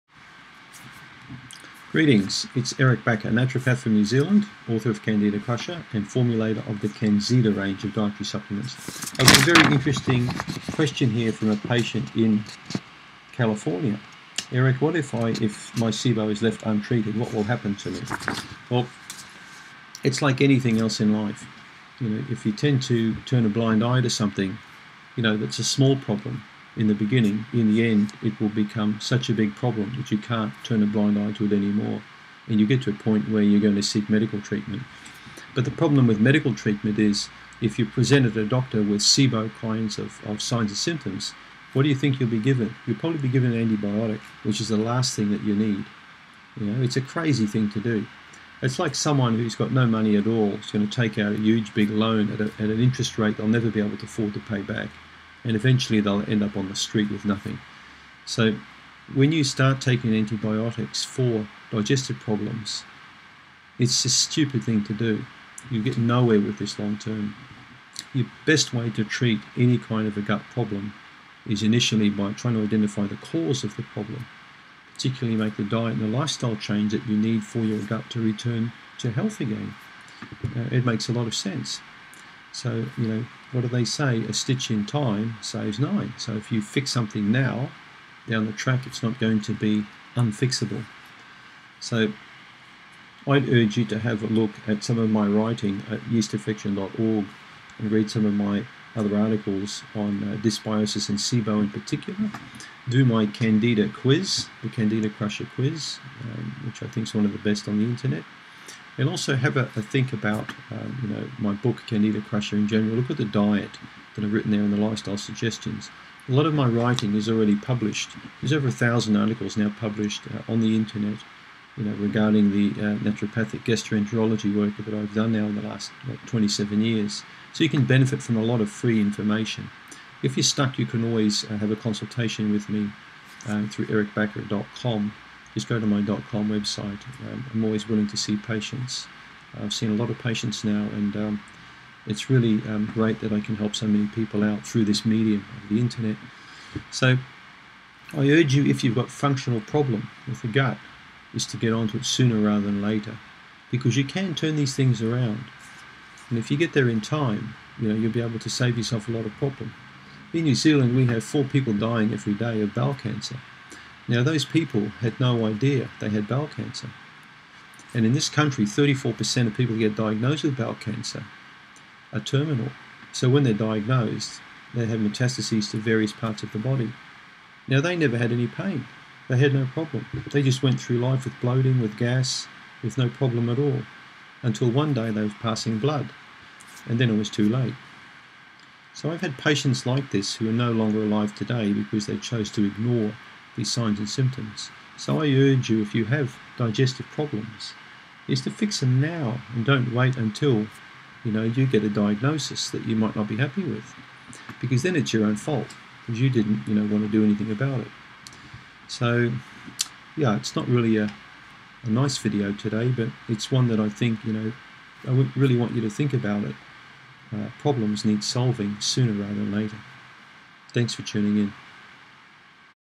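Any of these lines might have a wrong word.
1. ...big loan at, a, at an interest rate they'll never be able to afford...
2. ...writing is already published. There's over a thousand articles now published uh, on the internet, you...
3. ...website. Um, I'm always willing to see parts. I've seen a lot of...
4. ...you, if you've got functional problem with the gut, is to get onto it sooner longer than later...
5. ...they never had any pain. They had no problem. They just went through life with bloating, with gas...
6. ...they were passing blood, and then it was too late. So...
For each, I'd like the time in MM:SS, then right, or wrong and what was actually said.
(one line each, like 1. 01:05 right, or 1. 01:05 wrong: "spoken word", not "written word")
1. 00:51 right
2. 01:56 right
3. 02:16 wrong: "patients", not "parts"
4. 02:28 wrong: "rather", not "longer"
5. 02:57 right
6. 03:05 right.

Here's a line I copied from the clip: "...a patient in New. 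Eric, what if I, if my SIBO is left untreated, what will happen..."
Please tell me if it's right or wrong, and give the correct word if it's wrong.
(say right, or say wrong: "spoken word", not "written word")
wrong: "California", not "New".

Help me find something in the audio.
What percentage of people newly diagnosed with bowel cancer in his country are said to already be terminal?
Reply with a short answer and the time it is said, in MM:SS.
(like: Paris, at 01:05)
34%, at 02:48.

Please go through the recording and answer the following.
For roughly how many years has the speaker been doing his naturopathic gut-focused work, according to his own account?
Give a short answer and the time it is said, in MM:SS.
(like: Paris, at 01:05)
27, at 02:06.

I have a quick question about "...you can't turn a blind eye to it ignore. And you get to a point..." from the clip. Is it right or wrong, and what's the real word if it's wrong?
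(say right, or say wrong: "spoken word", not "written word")
wrong: "anymore", not "ignore".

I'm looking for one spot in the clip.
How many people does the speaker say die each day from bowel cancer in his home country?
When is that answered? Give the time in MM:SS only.
02:41.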